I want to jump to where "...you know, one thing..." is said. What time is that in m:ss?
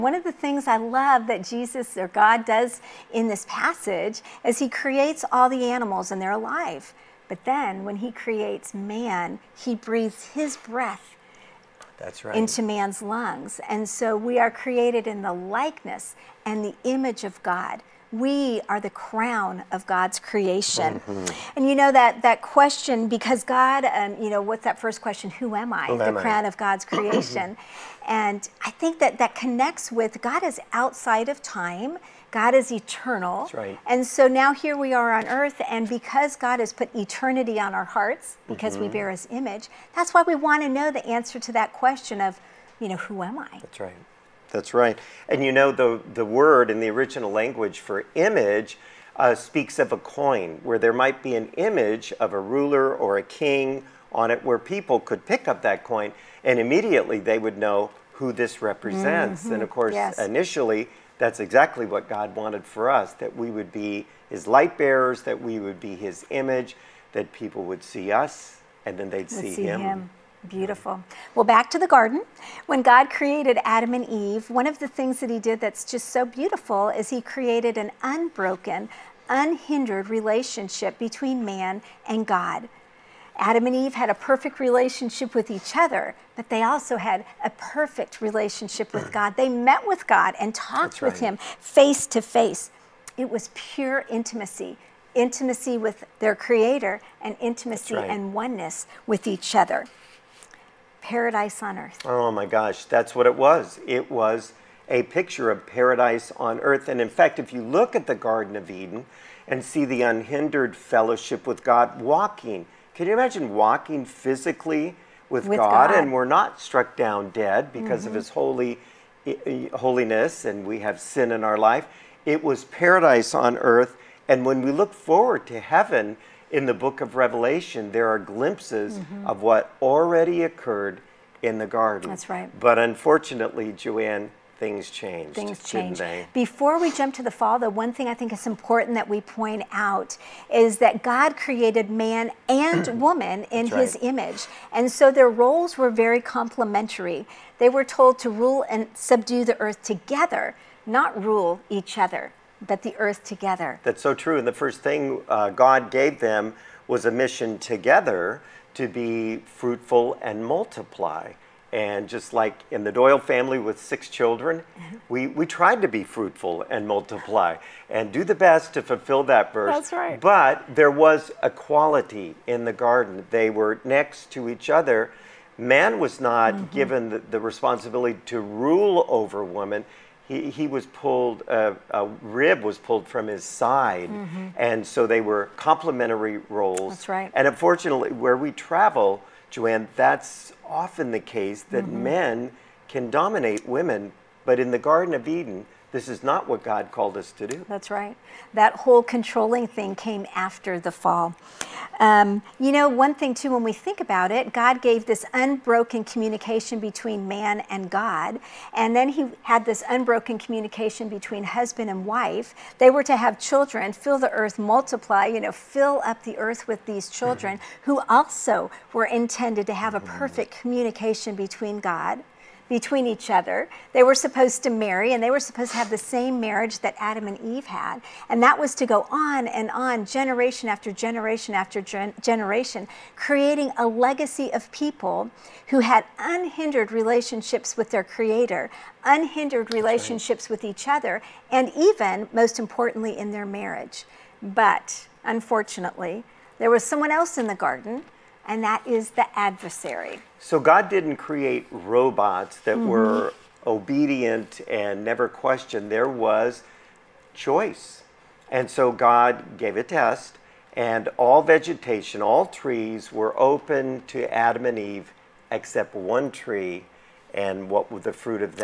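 3:22.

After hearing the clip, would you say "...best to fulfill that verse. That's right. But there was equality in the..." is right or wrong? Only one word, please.
right.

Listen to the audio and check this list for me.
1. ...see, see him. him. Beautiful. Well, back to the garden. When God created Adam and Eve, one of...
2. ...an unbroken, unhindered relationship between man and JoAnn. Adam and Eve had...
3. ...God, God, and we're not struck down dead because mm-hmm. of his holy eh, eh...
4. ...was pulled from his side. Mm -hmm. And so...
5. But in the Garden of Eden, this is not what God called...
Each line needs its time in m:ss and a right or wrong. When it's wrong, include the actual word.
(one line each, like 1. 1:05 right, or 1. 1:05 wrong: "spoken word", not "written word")
1. 1:09 right
2. 1:17 wrong: "God", not "JoAnn"
3. 1:55 right
4. 3:02 right
5. 3:14 right.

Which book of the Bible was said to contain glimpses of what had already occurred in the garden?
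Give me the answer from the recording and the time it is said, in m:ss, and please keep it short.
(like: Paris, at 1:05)
Revelation, at 2:07.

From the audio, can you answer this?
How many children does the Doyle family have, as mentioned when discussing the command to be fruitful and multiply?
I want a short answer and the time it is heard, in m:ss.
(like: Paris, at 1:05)
6, at 2:43.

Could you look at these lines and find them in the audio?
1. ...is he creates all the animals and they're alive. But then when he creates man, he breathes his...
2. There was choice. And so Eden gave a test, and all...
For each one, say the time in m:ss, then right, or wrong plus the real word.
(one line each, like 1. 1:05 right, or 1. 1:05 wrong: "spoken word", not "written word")
1. 0:04 right
2. 4:15 wrong: "God", not "Eden".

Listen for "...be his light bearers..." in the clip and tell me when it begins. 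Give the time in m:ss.
1:03.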